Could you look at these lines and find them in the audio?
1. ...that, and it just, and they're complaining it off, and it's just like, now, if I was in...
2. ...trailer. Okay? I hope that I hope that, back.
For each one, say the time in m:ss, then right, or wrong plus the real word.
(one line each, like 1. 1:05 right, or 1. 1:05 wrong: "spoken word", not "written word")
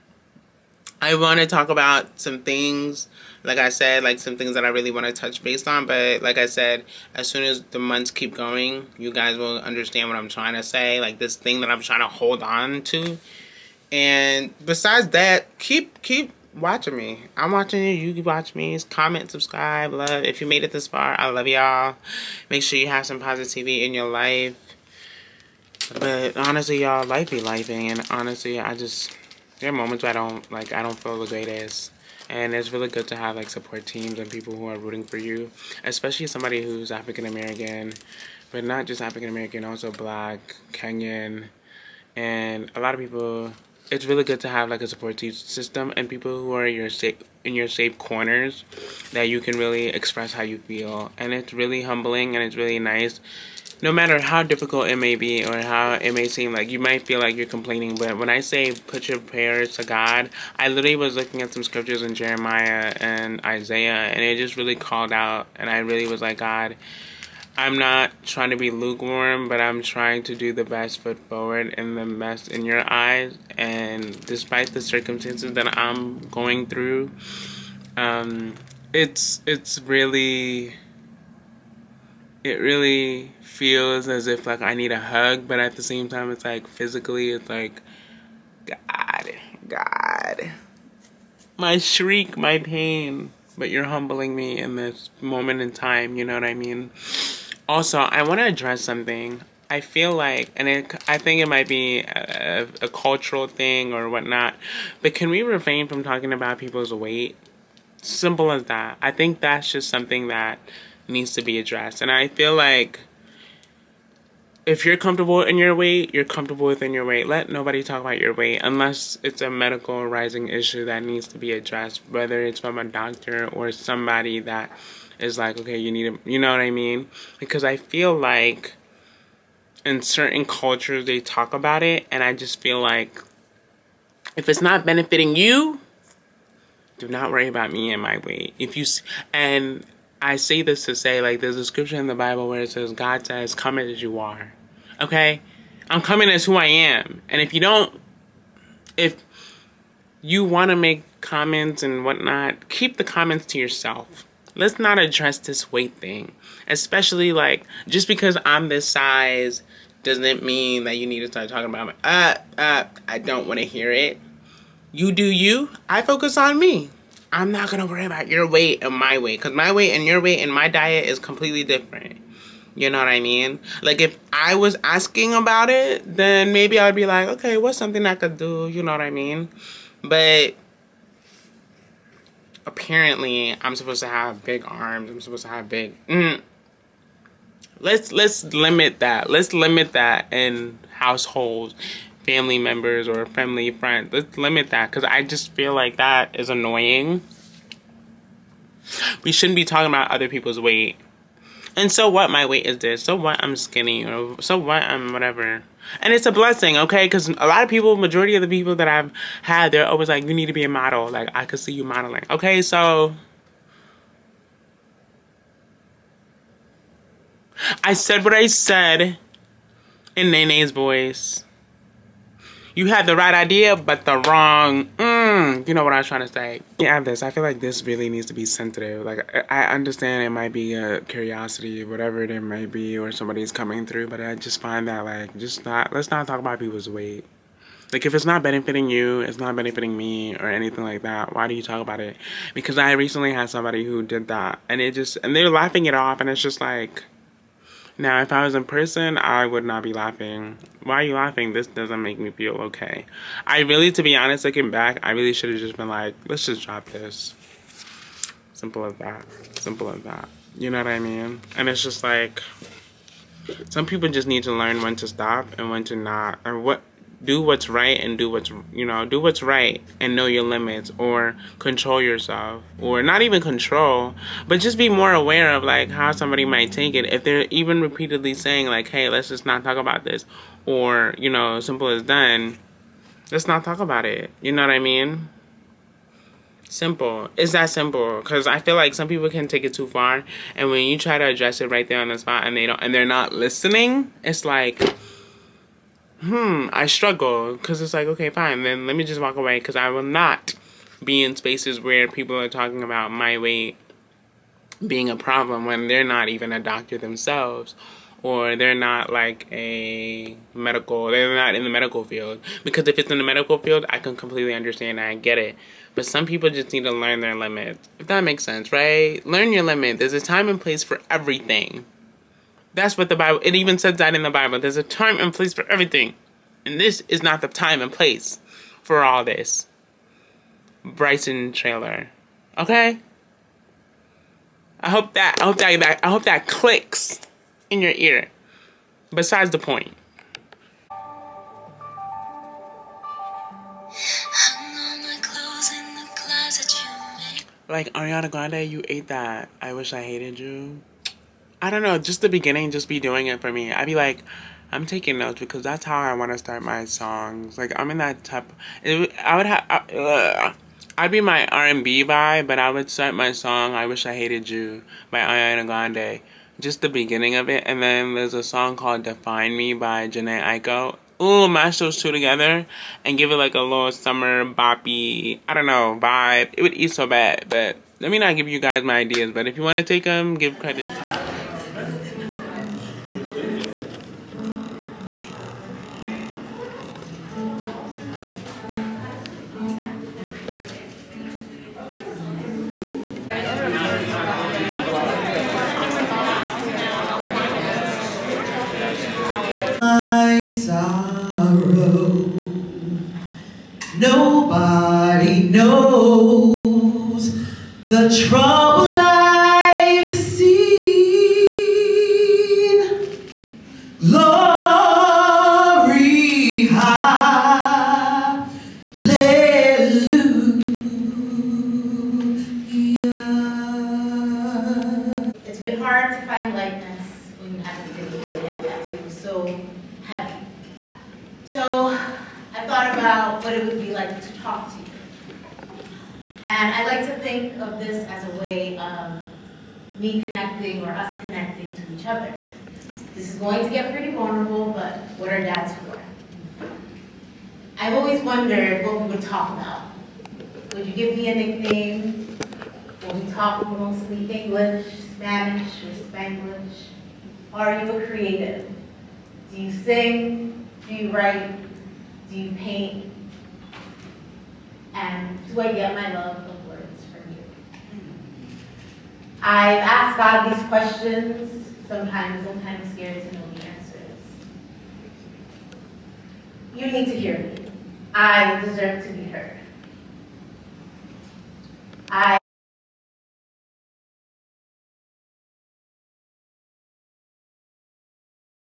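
1. 4:04 wrong: "laughing", not "complaining"
2. 5:31 right.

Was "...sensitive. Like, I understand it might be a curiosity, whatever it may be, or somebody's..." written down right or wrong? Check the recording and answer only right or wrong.
right.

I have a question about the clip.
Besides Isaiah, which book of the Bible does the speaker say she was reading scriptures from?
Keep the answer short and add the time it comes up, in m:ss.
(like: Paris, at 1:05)
Jeremiah, at 1:02.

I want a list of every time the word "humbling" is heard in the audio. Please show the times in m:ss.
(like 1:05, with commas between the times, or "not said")
0:51, 1:33.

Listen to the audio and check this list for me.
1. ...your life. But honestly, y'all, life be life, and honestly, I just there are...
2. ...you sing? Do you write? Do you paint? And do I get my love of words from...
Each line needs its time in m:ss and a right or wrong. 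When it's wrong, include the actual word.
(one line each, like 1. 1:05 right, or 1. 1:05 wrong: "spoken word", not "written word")
1. 0:23 right
2. 7:39 right.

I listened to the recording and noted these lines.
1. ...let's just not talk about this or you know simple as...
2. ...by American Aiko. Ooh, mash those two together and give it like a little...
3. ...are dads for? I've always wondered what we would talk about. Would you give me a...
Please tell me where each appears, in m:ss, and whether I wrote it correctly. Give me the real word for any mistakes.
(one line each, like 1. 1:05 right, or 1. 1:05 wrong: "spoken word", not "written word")
1. 4:39 right
2. 6:09 wrong: "Jhené", not "American"
3. 7:25 right.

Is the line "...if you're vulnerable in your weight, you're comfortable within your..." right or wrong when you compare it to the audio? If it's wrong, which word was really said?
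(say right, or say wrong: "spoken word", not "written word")
wrong: "comfortable", not "vulnerable".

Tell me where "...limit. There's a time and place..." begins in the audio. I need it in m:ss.
5:19.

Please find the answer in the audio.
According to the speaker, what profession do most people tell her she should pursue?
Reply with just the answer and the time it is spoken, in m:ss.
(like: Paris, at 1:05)
Model, at 3:30.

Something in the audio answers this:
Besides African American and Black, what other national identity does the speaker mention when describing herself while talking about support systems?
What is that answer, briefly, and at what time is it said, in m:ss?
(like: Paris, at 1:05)
Kenyan, at 0:40.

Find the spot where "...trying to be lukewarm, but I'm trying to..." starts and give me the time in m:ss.
1:08.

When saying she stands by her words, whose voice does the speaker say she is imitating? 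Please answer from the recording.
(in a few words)
Nene.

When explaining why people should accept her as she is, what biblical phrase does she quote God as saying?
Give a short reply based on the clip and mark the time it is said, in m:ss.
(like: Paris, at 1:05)
Come as you are, at 2:23.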